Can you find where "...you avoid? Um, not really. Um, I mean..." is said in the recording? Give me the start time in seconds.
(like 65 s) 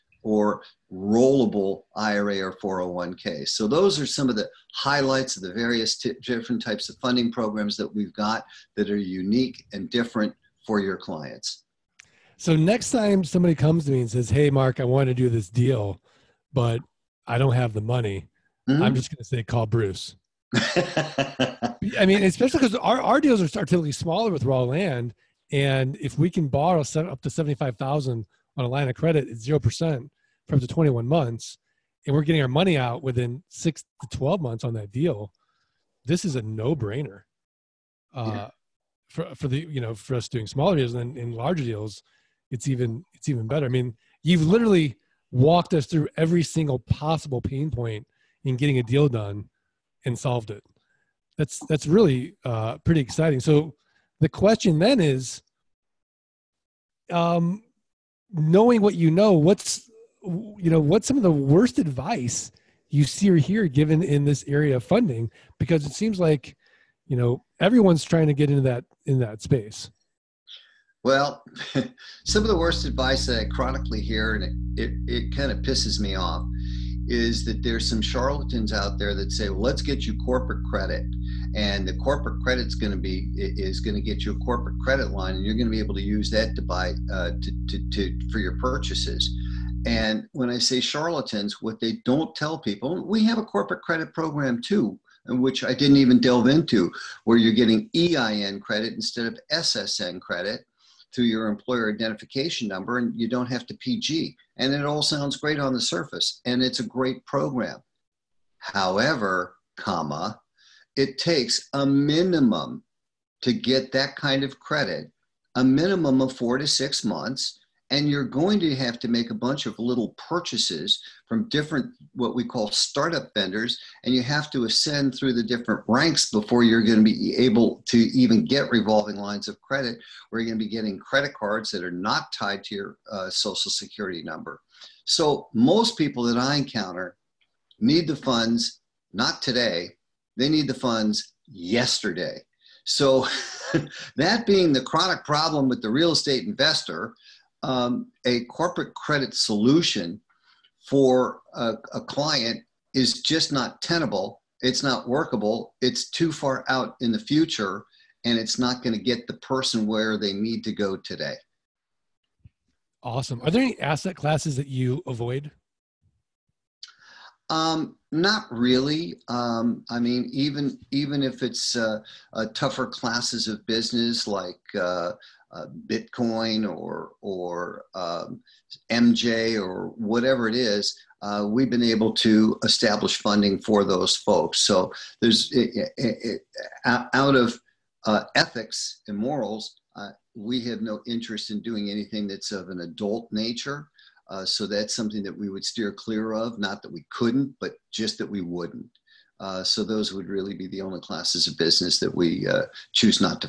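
164 s.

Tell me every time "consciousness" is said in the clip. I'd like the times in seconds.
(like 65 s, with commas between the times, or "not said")
not said.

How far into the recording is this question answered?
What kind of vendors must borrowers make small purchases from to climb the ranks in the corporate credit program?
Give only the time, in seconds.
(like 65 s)
122 s.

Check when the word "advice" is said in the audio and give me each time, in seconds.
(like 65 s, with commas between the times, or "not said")
61 s, 72 s.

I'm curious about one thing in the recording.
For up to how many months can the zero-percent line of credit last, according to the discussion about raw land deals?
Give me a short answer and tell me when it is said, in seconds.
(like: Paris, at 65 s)
21 months, at 30 s.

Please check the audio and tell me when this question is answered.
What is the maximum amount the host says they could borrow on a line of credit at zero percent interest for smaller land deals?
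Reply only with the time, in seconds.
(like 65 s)
27 s.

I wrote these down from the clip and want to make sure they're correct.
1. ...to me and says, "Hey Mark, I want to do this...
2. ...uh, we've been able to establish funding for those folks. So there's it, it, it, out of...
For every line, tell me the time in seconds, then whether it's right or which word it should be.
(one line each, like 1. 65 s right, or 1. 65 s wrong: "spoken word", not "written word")
1. 13 s right
2. 181 s right.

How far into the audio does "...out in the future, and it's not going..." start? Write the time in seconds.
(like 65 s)
156 s.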